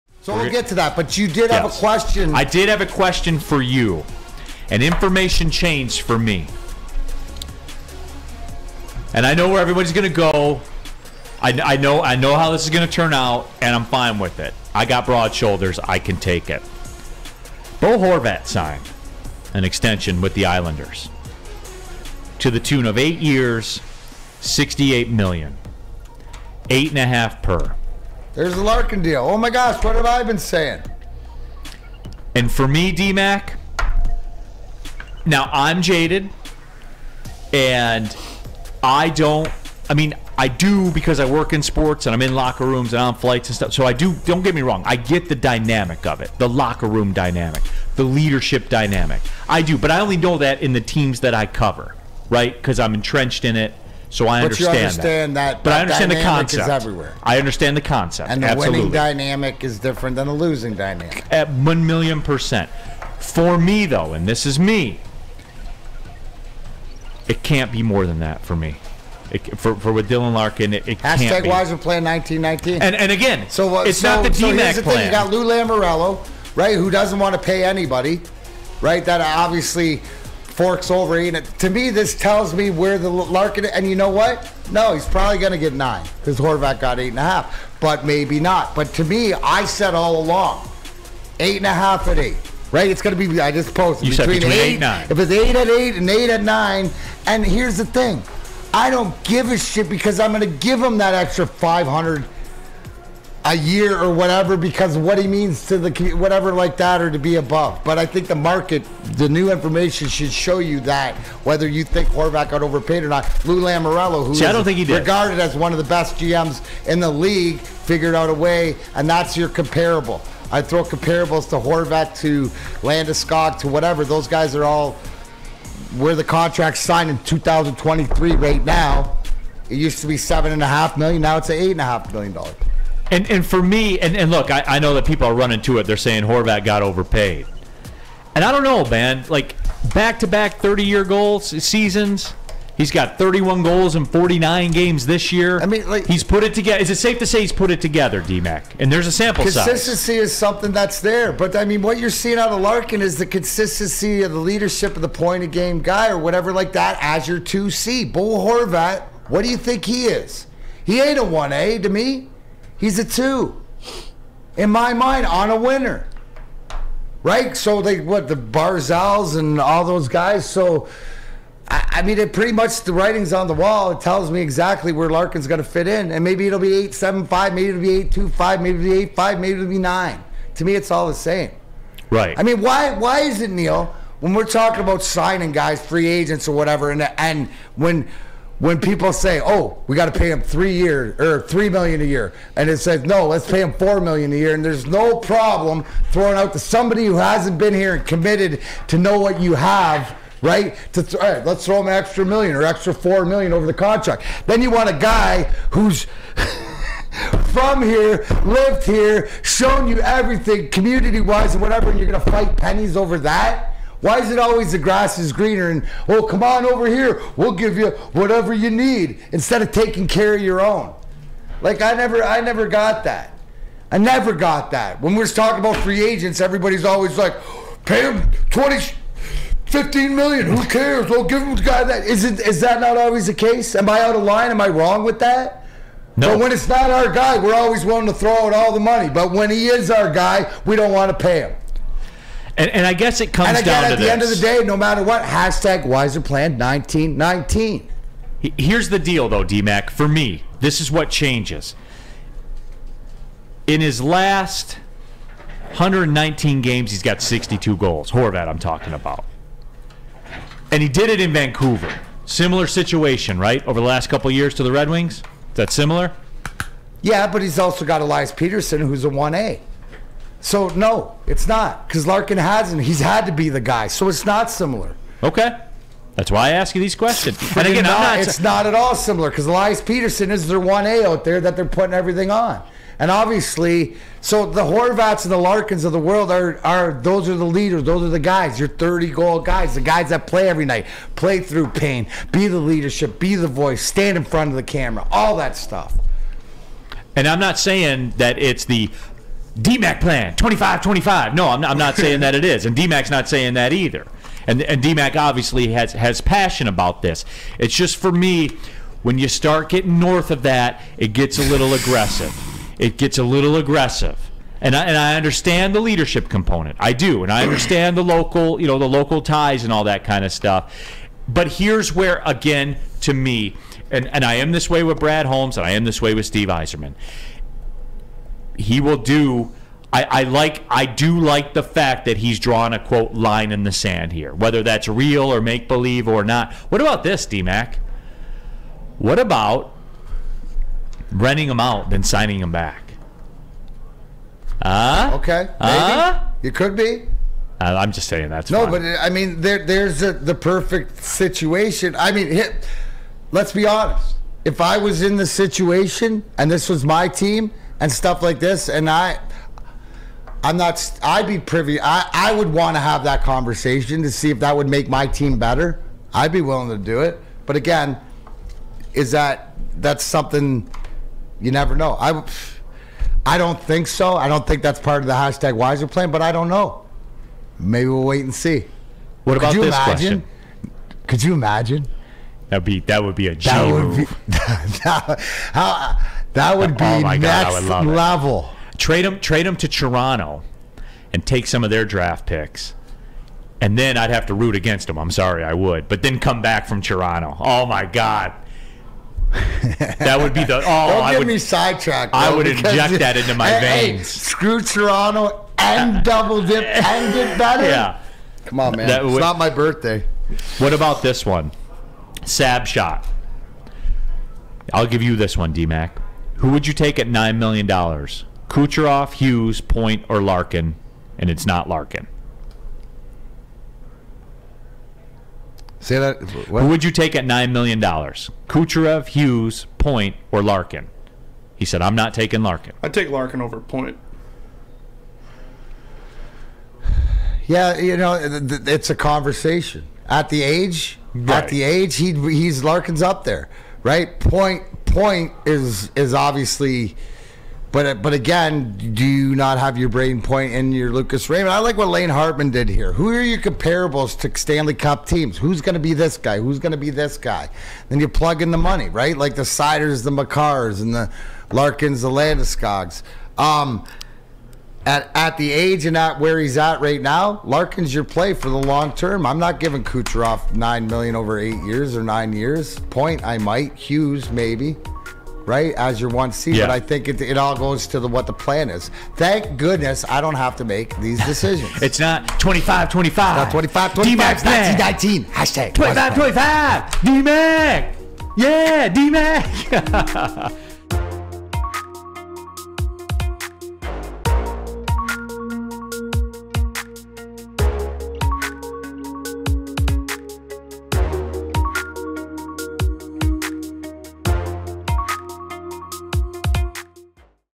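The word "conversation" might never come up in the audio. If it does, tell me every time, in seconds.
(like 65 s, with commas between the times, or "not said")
363 s, 438 s.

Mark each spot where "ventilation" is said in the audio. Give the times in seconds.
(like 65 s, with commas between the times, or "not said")
not said.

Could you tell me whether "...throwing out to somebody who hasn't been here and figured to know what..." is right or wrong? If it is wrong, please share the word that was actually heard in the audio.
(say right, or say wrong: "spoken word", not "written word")
wrong: "committed", not "figured".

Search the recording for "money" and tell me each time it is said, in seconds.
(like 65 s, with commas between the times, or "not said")
238 s, 458 s.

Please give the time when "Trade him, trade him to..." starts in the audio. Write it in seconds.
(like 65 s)
388 s.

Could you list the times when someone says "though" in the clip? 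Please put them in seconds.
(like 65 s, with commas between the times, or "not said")
63 s, 249 s.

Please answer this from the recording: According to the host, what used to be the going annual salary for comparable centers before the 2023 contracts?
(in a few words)
$7.5 million.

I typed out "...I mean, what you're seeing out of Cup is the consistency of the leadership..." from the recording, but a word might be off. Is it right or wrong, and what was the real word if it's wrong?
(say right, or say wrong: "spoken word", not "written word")
wrong: "Larkin", not "Cup".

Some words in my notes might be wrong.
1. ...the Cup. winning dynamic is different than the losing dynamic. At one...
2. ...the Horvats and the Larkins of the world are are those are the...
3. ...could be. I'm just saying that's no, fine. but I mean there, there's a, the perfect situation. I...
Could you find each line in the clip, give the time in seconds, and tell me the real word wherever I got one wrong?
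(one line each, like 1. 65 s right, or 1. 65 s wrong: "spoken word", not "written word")
1. 58 s wrong: "Absolutely", not "Cup"
2. 284 s right
3. 346 s right.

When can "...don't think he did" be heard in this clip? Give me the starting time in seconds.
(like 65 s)
114 s.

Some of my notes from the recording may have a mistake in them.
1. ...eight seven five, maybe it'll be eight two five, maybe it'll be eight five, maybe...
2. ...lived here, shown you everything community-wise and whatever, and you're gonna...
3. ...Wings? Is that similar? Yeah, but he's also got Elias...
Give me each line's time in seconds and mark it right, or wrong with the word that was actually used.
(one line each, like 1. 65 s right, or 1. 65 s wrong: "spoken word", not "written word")
1. 176 s right
2. 208 s right
3. 264 s right.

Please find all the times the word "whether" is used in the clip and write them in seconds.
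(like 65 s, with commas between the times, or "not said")
111 s, 334 s.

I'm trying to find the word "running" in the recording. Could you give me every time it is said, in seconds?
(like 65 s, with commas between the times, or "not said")
135 s.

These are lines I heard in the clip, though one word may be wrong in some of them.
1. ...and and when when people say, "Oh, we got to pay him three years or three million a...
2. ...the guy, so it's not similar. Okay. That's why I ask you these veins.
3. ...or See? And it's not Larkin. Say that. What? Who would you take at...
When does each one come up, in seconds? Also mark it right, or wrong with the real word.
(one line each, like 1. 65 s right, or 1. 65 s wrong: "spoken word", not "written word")
1. 186 s right
2. 273 s wrong: "questions", not "veins"
3. 420 s wrong: "Larkin", not "See".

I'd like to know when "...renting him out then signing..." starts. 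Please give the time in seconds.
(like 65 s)
341 s.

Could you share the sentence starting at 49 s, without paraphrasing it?
I do, but I only know that in the teams that I cover, right?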